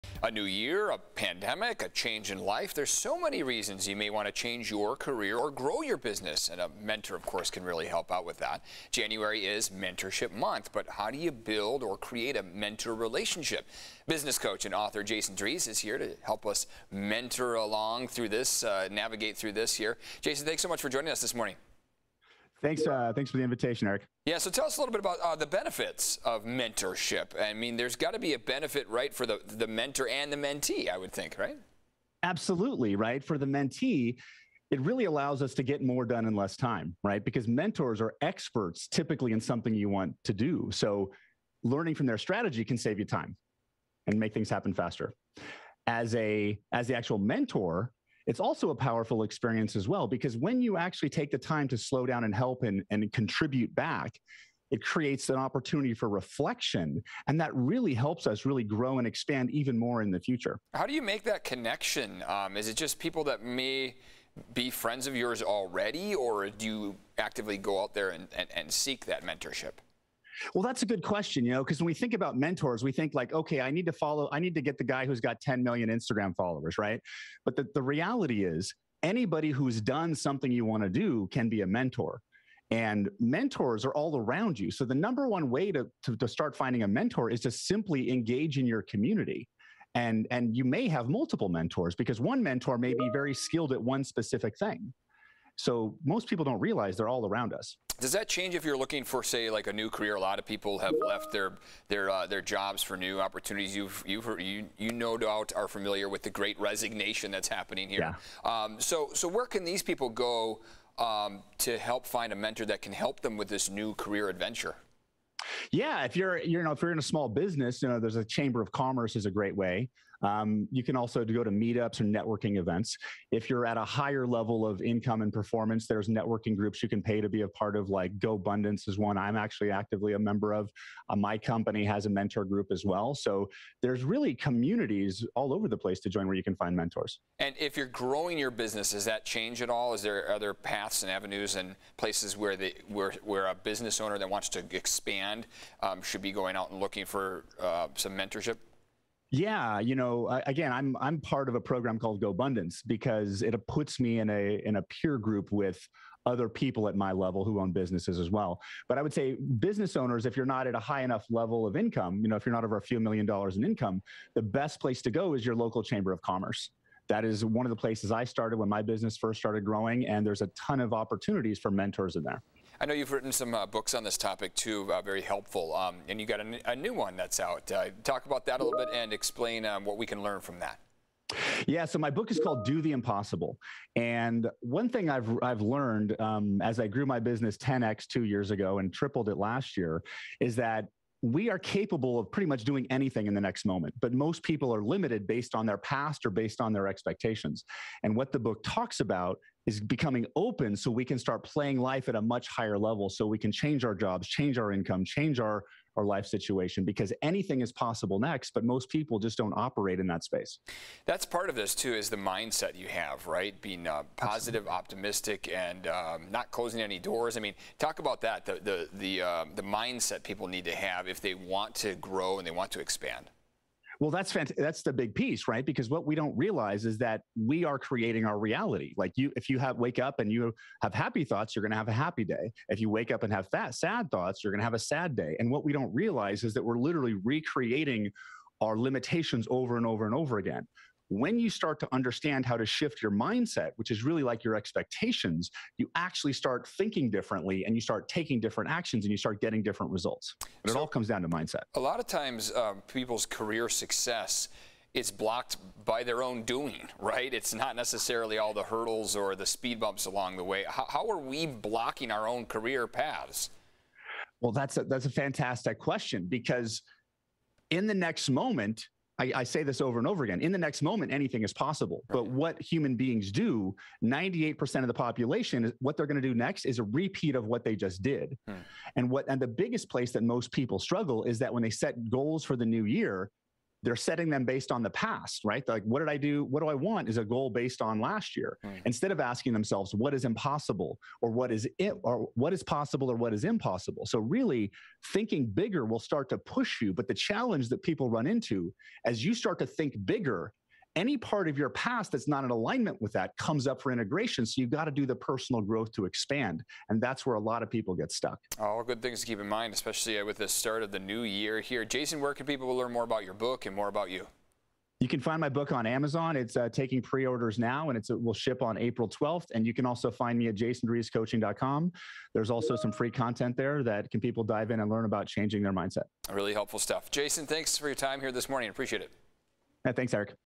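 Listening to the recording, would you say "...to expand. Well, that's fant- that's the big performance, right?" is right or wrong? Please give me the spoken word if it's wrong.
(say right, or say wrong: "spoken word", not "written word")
wrong: "piece", not "performance".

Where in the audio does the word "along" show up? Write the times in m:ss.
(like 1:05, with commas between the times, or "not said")
0:17, 4:20.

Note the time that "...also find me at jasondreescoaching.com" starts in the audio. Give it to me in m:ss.
5:19.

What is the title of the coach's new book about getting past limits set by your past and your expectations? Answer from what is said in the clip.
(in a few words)
Do the Impossible.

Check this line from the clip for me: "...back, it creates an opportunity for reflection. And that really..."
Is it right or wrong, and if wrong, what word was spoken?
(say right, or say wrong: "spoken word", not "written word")
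right.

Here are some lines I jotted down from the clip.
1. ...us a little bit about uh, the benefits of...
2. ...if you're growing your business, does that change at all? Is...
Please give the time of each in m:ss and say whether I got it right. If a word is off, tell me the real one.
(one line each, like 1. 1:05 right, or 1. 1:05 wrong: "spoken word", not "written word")
1. 0:24 right
2. 2:17 right.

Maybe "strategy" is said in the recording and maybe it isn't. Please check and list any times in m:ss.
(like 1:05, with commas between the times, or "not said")
0:42.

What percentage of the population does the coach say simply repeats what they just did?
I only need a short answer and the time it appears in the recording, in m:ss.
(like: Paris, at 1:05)
98%, at 4:34.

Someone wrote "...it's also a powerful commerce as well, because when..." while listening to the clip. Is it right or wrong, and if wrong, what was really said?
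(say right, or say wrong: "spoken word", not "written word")
wrong: "experience", not "commerce".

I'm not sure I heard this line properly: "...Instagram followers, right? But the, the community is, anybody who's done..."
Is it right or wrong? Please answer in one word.
wrong.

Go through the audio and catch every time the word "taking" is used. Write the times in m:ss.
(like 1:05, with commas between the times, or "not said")
4:08, 5:16.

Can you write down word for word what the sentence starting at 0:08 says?
January is Mentorship Month, but how do you build or create a mentor relationship?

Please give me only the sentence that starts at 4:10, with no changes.
But so it all comes down to mindset.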